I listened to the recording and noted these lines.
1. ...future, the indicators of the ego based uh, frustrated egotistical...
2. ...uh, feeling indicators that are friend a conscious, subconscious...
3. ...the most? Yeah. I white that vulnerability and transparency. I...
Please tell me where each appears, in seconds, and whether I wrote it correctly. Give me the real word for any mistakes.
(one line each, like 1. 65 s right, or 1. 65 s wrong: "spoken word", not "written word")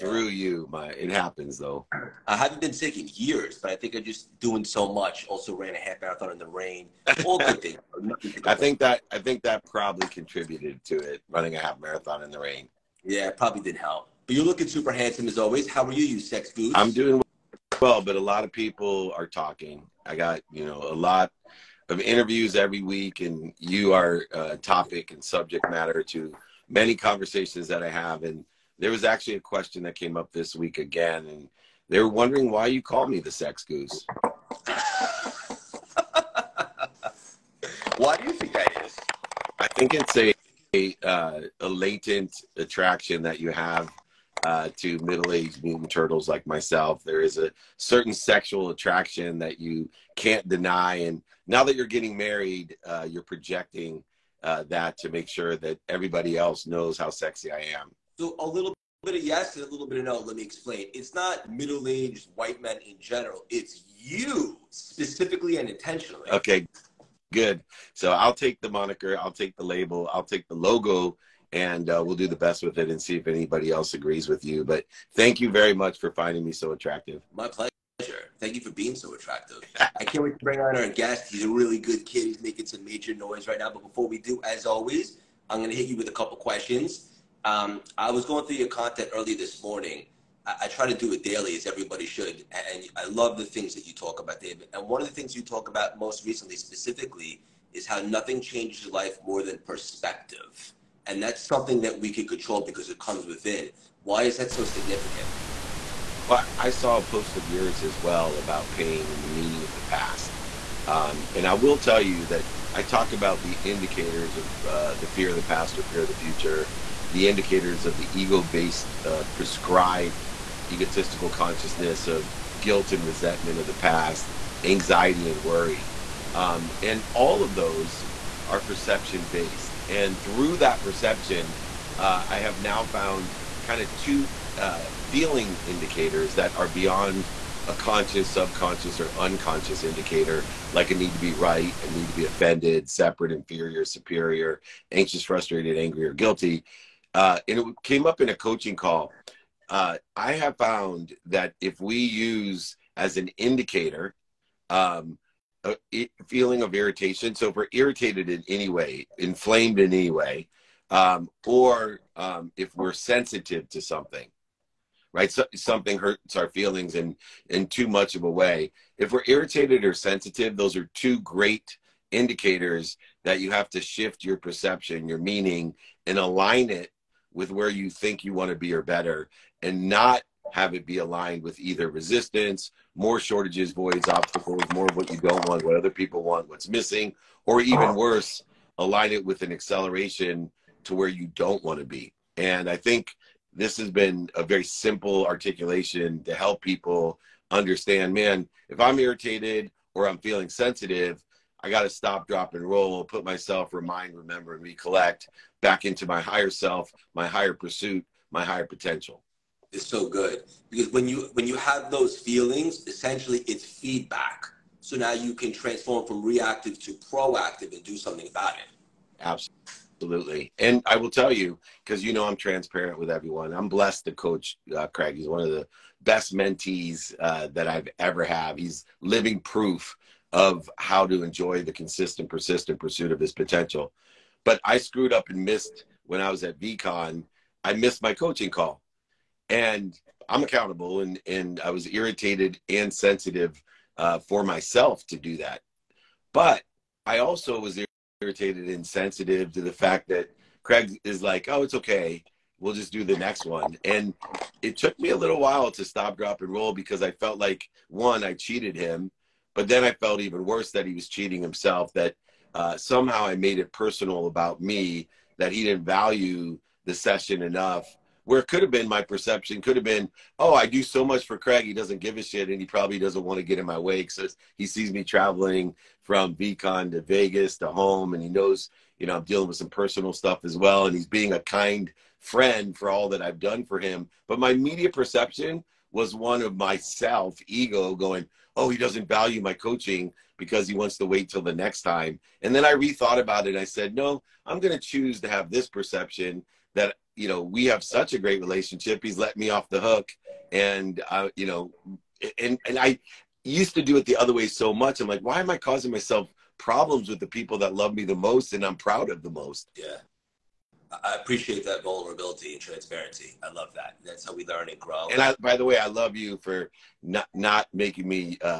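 1. 116 s wrong: "prescribed", not "frustrated"
2. 134 s wrong: "beyond", not "friend"
3. 309 s wrong: "appreciate", not "white".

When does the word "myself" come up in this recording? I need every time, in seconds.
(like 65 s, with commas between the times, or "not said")
46 s, 203 s, 244 s, 286 s, 305 s.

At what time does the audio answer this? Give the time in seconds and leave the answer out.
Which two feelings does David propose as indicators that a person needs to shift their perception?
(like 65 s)
169 s.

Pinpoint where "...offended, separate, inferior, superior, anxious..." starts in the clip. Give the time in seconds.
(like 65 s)
142 s.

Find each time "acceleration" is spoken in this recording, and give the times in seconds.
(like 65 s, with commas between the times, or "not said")
189 s.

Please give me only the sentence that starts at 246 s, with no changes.
But I also was irritated and sensitive to the fact that Craig is like, oh, it's okay.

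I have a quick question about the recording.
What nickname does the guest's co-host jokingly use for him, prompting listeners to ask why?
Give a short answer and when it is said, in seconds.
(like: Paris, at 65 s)
sex goose, at 33 s.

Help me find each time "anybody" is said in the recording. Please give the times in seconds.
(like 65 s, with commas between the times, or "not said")
73 s.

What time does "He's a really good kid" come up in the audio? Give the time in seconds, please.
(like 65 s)
81 s.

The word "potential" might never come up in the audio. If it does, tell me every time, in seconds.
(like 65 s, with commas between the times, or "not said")
208 s, 233 s.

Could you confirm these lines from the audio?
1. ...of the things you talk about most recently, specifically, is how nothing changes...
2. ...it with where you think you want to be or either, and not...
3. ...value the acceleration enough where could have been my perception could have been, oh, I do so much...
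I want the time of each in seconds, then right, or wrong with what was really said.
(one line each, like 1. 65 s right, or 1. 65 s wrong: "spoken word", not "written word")
1. 95 s right
2. 176 s wrong: "better", not "either"
3. 265 s wrong: "session", not "acceleration".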